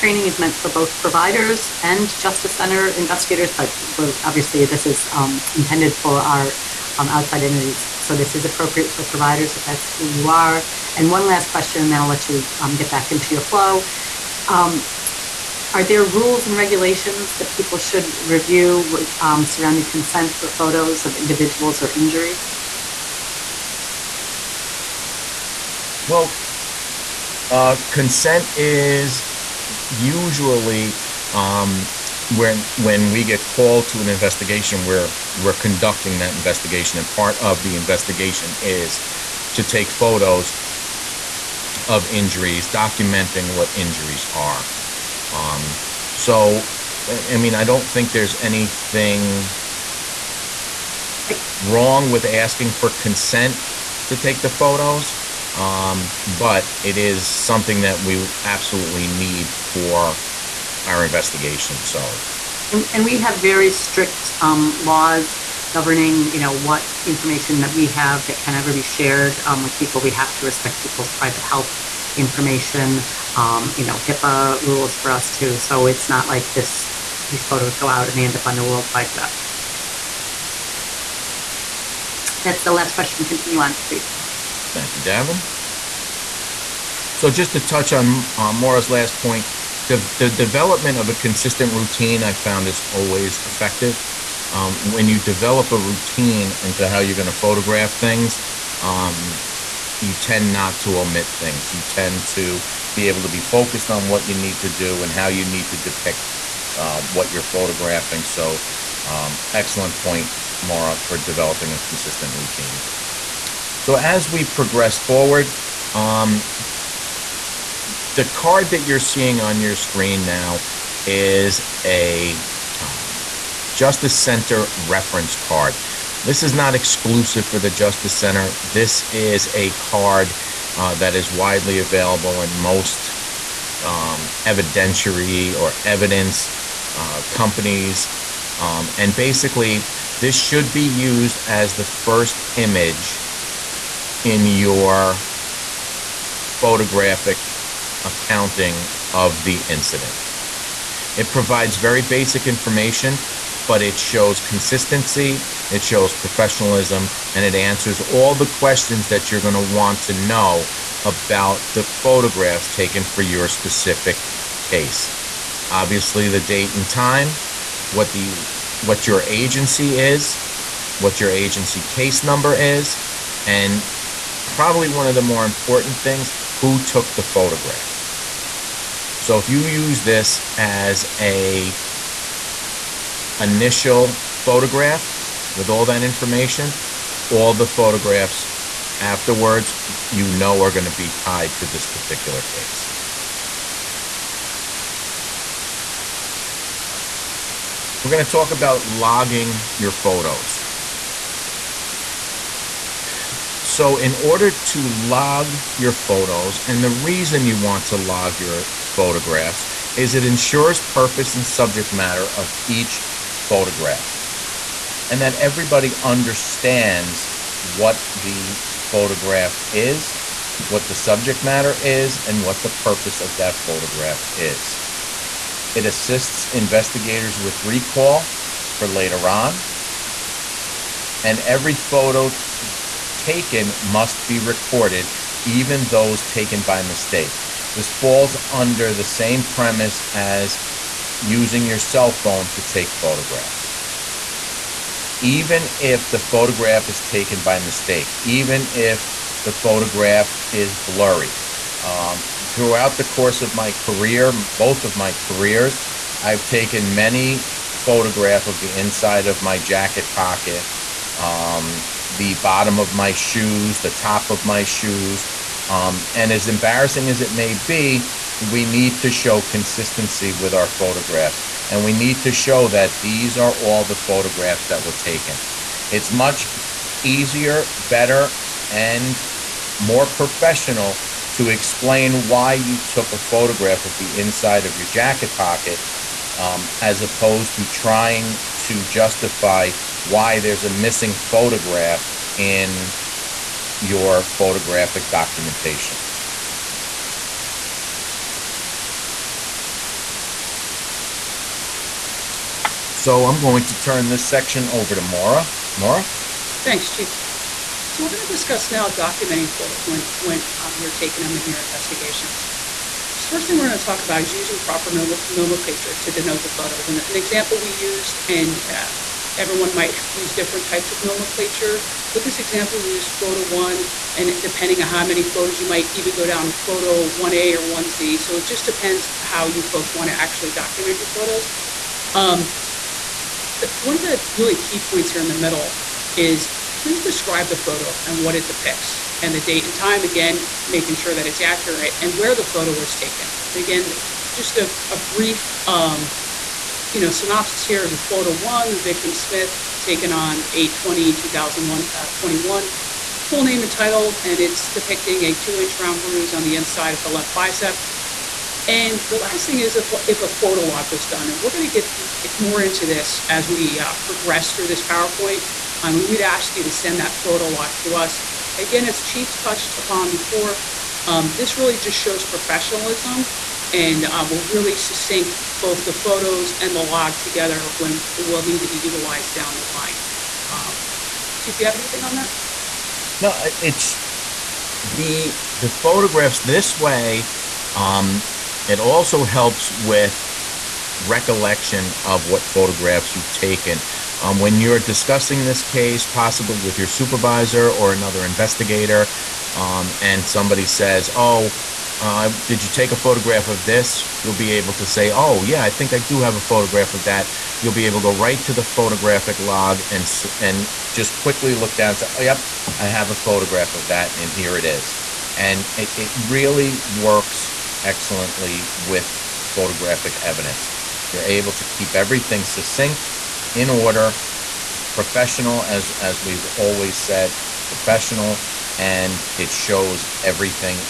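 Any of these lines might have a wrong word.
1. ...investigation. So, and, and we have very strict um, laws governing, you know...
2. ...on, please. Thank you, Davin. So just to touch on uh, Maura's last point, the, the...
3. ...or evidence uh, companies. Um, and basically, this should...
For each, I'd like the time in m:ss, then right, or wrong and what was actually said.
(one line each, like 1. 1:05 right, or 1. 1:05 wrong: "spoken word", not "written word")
1. 1:01 right
2. 1:23 right
3. 2:15 right.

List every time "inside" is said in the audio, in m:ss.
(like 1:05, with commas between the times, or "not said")
4:18, 4:44, 5:56.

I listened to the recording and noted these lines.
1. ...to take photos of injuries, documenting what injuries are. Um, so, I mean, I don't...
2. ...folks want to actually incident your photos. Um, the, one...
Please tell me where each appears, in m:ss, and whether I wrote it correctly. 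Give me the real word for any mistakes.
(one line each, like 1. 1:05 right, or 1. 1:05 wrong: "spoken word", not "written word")
1. 0:39 right
2. 5:29 wrong: "document", not "incident".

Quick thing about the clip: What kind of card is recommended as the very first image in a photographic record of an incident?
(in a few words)
Justice Center reference card.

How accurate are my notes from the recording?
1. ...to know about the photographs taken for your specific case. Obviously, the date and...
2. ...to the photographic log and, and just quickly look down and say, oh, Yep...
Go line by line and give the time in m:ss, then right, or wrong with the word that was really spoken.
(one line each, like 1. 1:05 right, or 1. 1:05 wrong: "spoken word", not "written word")
1. 2:40 right
2. 6:48 right.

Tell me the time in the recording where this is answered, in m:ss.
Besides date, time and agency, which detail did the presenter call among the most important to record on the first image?
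2:56.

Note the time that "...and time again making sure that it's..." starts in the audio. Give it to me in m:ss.
5:39.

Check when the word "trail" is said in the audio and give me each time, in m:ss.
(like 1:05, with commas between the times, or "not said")
not said.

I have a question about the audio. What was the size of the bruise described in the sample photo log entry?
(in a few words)
2 inch round.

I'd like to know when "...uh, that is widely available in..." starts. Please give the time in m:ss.
2:10.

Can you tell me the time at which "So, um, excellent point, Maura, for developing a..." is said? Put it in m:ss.
1:48.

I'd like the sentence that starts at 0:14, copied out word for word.
Um, are there rules and regulations that people should review um, surrounding consent for photos of individuals or injuries?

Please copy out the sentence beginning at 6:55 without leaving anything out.
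And it, it really works excellently with photographic evidence.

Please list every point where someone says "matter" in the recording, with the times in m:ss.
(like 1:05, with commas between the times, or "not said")
3:31, 3:41.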